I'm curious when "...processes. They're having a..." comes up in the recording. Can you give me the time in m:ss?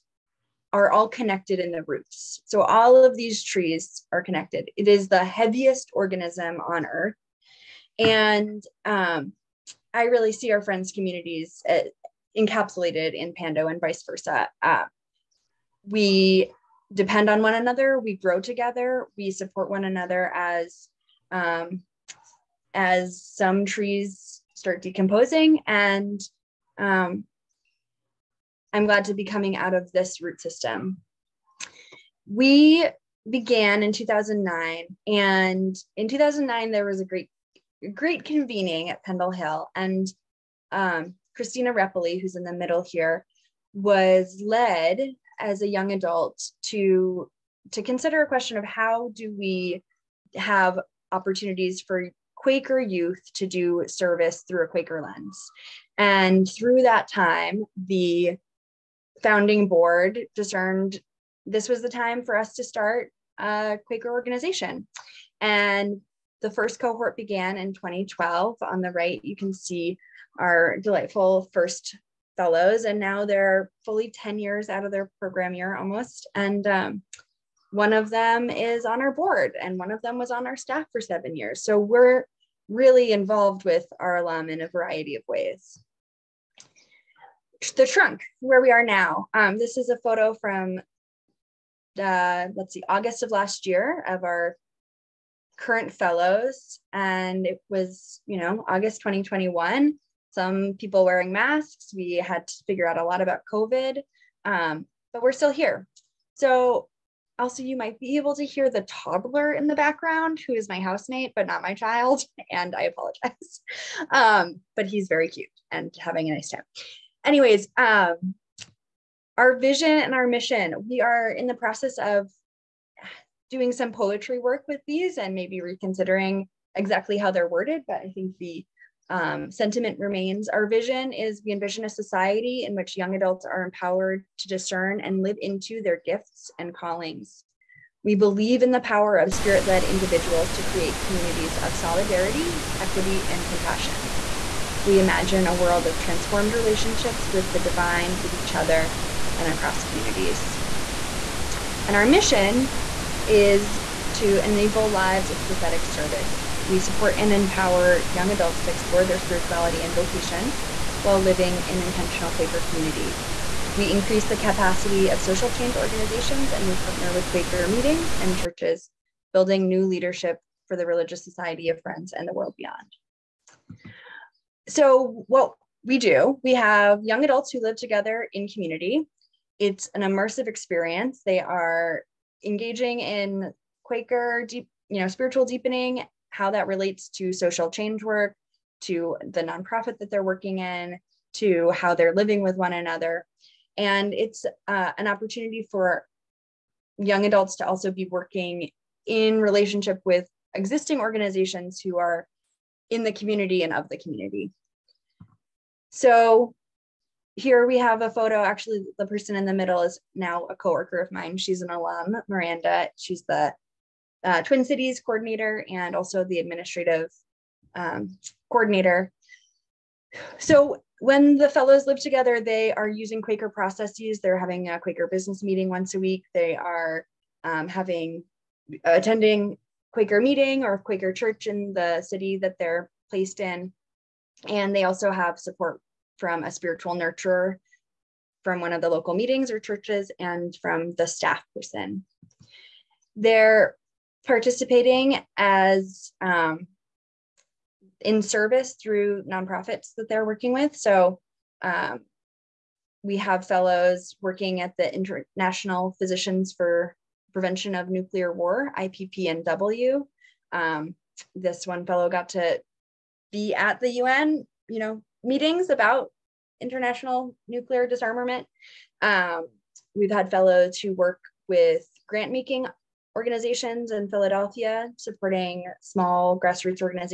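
3:43.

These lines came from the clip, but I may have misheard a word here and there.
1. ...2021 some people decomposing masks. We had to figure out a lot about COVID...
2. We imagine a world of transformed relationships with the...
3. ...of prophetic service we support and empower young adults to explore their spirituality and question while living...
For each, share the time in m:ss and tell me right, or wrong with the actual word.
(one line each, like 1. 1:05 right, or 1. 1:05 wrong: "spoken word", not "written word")
1. 1:39 wrong: "wearing", not "decomposing"
2. 2:24 right
3. 2:35 wrong: "vocation", not "question".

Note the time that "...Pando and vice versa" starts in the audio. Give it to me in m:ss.
0:13.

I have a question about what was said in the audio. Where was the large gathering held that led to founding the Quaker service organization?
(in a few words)
Pendle Hill.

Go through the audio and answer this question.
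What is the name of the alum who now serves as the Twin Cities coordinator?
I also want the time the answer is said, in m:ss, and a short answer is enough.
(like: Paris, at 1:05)
Miranda, at 3:32.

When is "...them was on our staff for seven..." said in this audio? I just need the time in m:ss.
1:20.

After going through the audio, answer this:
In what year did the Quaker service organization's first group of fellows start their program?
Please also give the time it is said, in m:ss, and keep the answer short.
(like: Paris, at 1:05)
2012, at 1:07.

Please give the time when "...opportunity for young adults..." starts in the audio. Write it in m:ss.
3:15.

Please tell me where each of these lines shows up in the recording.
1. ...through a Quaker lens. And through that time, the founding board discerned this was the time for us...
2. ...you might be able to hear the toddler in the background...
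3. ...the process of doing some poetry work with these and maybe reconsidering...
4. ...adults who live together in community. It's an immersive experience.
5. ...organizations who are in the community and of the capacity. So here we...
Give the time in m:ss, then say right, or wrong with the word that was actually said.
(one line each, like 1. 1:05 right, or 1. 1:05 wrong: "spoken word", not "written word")
1. 0:54 right
2. 1:47 right
3. 2:01 right
4. 2:57 right
5. 3:21 wrong: "community", not "capacity".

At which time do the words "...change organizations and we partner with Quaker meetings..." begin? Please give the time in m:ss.
2:45.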